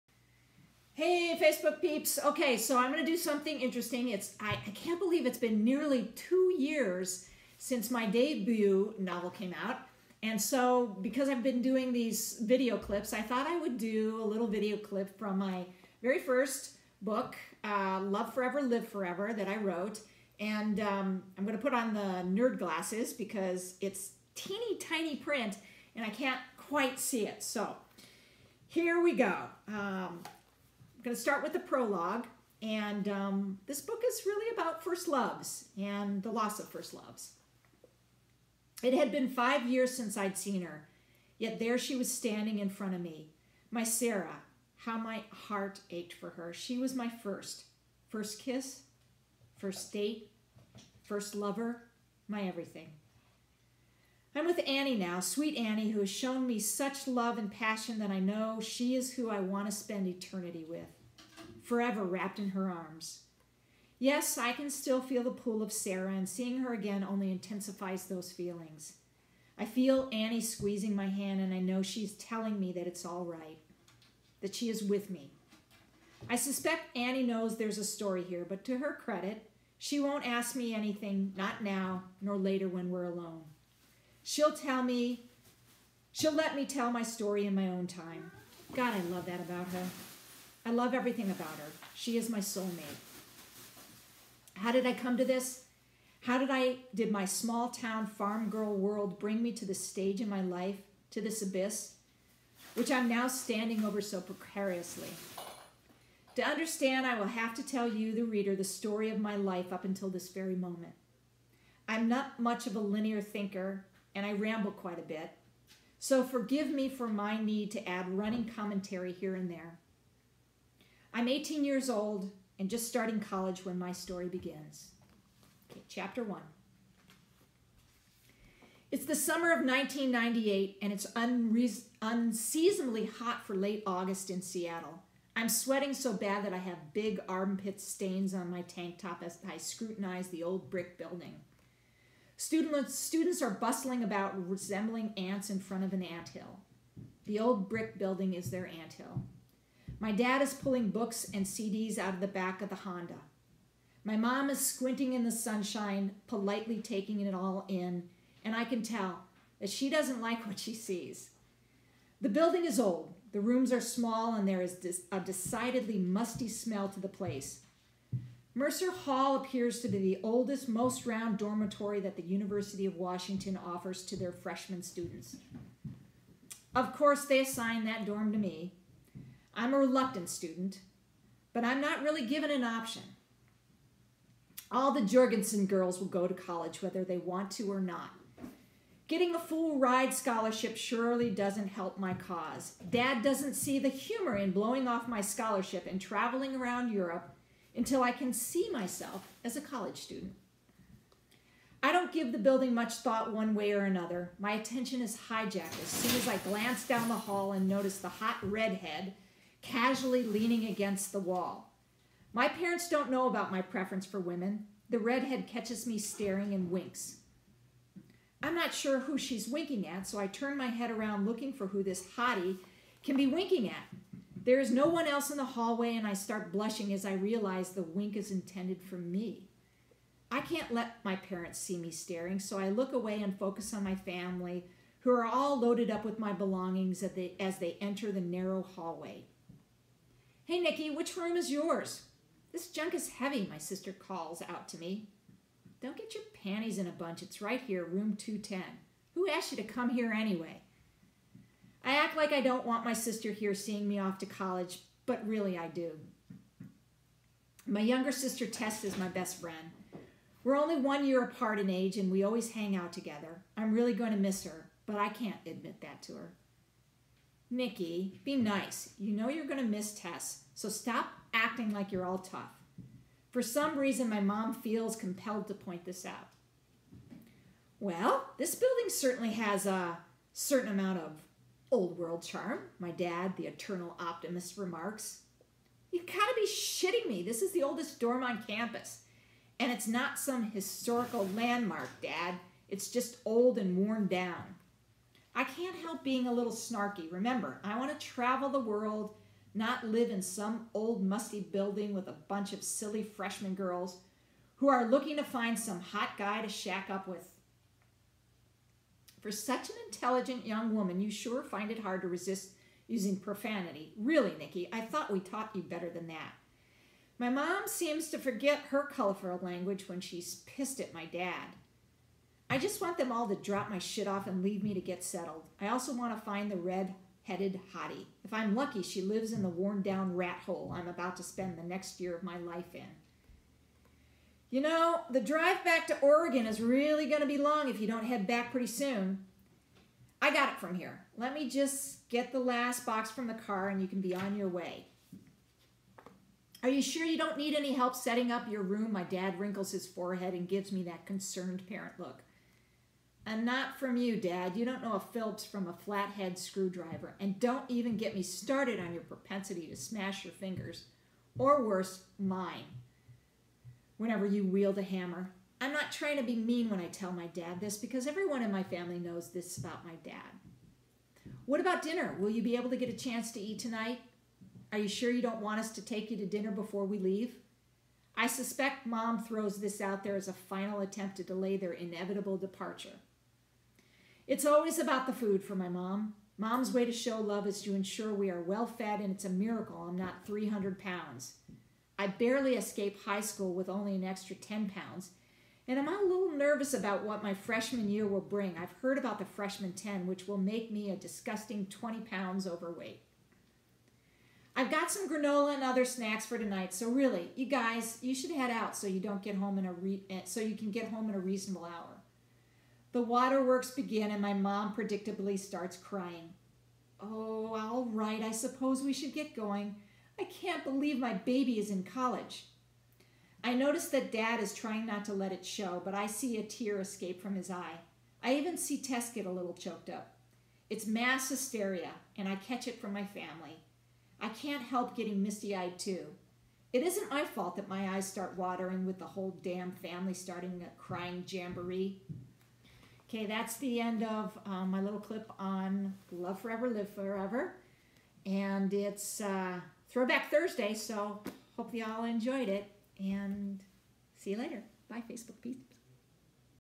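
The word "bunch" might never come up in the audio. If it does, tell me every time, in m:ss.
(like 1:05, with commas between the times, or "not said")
4:06, 5:02.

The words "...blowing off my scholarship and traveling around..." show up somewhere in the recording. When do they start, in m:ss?
3:14.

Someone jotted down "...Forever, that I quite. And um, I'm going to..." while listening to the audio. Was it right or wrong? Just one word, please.
wrong.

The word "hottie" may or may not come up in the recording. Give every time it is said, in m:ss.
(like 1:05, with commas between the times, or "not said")
3:42, 5:27.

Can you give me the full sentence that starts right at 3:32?
My parents don't know about my preference for women.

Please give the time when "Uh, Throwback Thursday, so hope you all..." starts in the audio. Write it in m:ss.
7:29.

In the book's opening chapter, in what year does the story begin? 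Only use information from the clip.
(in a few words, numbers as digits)
1998.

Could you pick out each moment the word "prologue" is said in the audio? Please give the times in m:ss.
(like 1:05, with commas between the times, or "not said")
0:31.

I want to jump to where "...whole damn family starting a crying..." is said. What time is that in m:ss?
7:19.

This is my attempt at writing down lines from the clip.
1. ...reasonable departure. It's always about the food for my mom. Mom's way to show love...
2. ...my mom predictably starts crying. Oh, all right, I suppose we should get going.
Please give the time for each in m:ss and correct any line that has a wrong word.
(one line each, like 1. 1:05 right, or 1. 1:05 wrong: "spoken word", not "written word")
1. 6:21 wrong: "inevitable", not "reasonable"
2. 6:54 right.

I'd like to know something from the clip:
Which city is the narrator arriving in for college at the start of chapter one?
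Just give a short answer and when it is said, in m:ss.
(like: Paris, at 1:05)
Seattle, at 2:14.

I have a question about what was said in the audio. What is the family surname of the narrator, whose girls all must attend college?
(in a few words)
Jorgensen.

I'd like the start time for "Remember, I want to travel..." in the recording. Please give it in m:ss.
4:57.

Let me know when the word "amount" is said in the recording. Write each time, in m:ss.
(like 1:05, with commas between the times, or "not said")
4:40.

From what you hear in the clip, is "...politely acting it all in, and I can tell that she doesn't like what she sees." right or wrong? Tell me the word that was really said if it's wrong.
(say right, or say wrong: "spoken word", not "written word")
wrong: "taking", not "acting".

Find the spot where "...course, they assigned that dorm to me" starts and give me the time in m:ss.
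2:56.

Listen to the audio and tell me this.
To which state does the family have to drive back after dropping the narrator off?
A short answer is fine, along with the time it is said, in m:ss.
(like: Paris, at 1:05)
Oregon, at 5:36.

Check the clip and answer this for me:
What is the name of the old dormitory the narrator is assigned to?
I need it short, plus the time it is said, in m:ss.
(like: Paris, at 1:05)
Mercer Hall, at 2:48.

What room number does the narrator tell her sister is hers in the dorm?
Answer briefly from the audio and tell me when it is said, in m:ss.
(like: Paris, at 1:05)
210, at 4:08.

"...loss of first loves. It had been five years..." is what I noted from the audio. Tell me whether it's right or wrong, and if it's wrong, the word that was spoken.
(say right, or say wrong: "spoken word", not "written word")
right.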